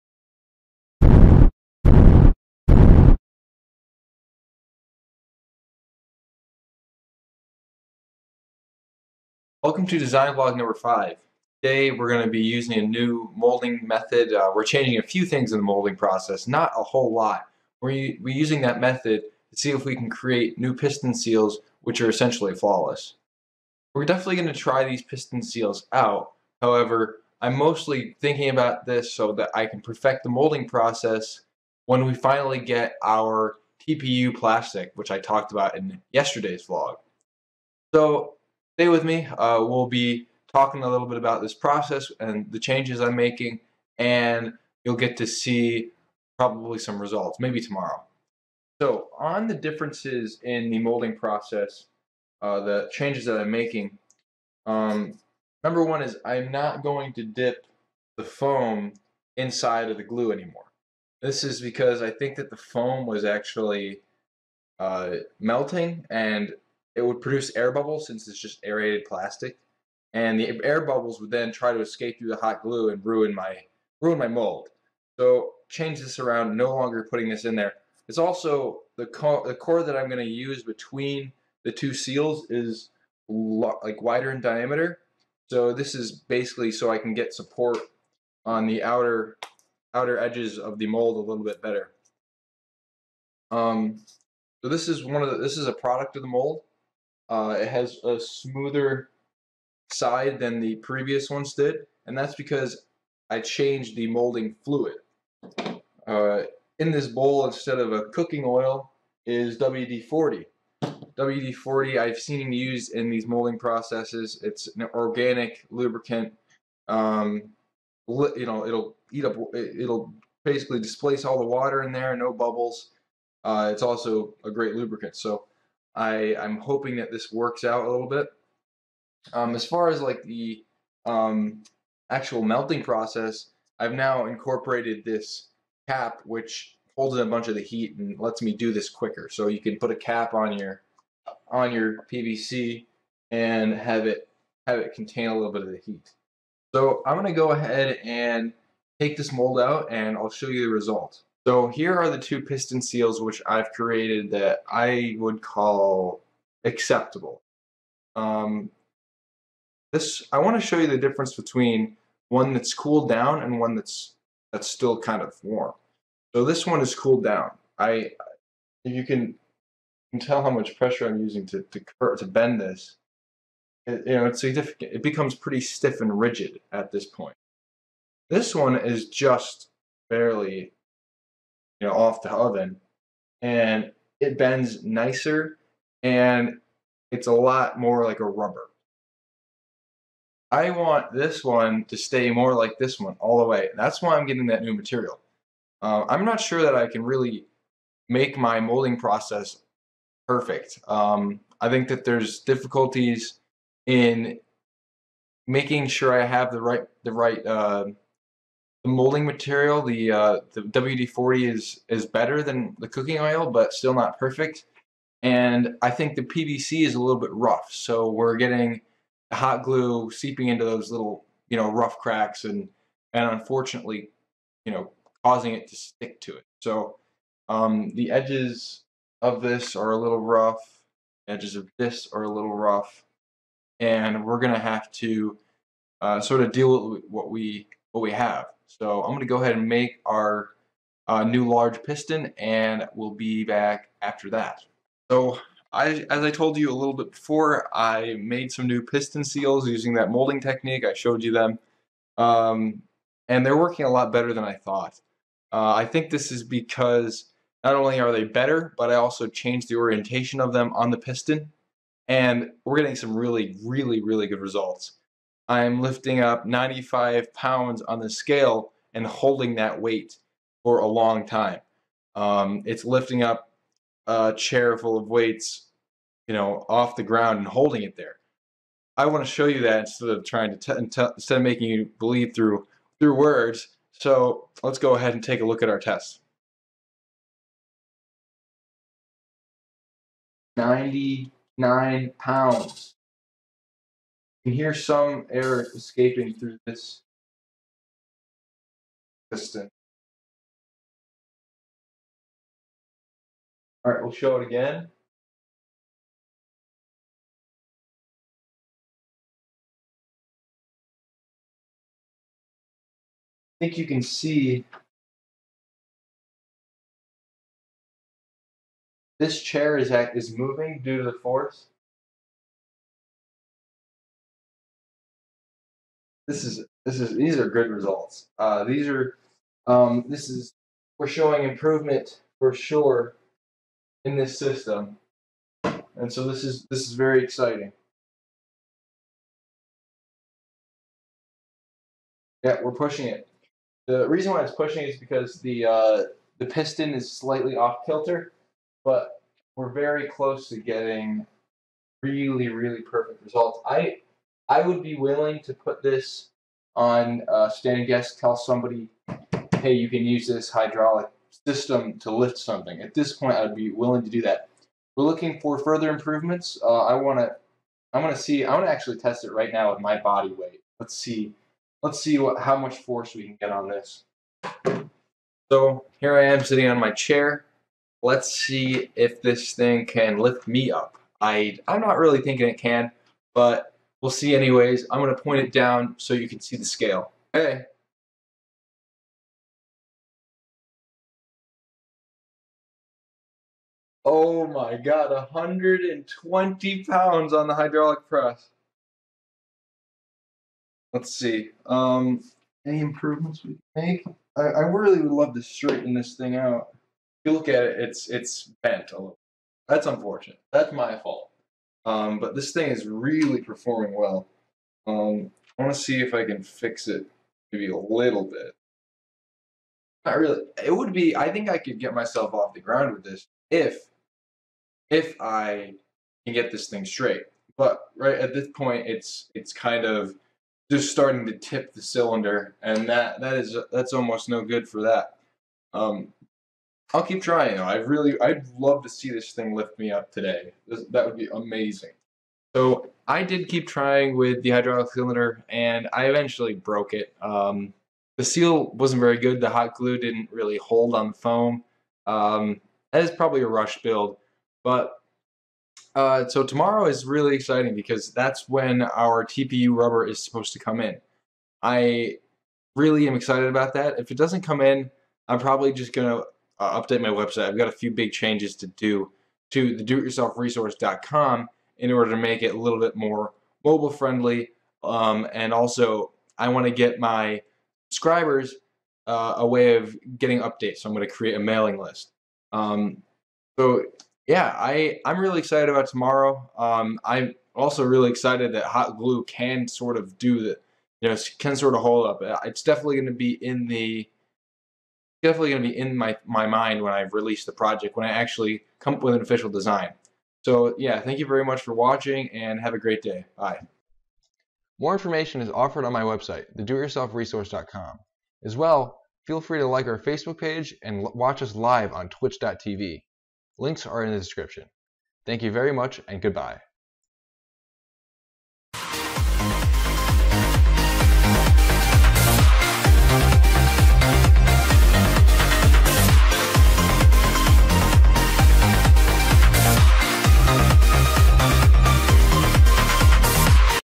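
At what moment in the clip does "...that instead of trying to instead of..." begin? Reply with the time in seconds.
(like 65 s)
279 s.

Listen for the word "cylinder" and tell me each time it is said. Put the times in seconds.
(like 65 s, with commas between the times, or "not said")
431 s, 444 s.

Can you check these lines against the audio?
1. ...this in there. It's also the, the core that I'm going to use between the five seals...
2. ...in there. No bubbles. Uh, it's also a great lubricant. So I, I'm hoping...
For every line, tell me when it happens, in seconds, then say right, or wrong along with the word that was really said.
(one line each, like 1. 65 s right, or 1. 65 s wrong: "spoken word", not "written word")
1. 77 s wrong: "two", not "five"
2. 121 s right.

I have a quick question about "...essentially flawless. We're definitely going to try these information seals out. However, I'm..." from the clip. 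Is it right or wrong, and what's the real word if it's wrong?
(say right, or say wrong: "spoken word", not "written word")
wrong: "piston", not "information".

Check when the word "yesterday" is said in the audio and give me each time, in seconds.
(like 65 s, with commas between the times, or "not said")
36 s.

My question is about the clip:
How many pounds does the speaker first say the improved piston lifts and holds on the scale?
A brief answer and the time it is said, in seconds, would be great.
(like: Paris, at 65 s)
95, at 266 s.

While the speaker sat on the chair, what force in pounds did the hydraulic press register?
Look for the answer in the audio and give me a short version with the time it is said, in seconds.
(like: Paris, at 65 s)
120, at 395 s.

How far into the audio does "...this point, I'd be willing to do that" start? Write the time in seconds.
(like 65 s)
362 s.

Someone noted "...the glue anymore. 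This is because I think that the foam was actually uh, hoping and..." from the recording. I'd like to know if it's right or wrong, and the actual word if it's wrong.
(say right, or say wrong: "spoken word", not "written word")
wrong: "melting", not "hoping".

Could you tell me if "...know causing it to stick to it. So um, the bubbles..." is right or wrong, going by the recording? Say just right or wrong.
wrong.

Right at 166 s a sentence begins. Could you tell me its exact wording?
So this one is cooled down.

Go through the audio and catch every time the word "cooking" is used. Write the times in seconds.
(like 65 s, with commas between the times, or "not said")
108 s, 212 s.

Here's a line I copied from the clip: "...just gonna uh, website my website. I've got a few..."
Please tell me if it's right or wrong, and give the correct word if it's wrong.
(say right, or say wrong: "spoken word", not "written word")
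wrong: "update", not "website".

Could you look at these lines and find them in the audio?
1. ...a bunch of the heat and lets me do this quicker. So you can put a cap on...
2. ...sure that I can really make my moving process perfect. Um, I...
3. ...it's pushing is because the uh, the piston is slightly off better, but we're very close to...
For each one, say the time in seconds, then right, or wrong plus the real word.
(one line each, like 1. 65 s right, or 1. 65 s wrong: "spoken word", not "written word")
1. 137 s right
2. 196 s wrong: "molding", not "moving"
3. 344 s wrong: "kilter", not "better".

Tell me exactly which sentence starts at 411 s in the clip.
Um, but this thing is really performing well.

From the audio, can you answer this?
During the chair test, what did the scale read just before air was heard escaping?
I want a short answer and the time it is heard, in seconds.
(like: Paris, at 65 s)
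99 pounds, at 290 s.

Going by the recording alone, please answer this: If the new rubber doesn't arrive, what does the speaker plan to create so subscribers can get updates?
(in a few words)
mailing list.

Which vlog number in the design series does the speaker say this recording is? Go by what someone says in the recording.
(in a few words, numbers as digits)
5.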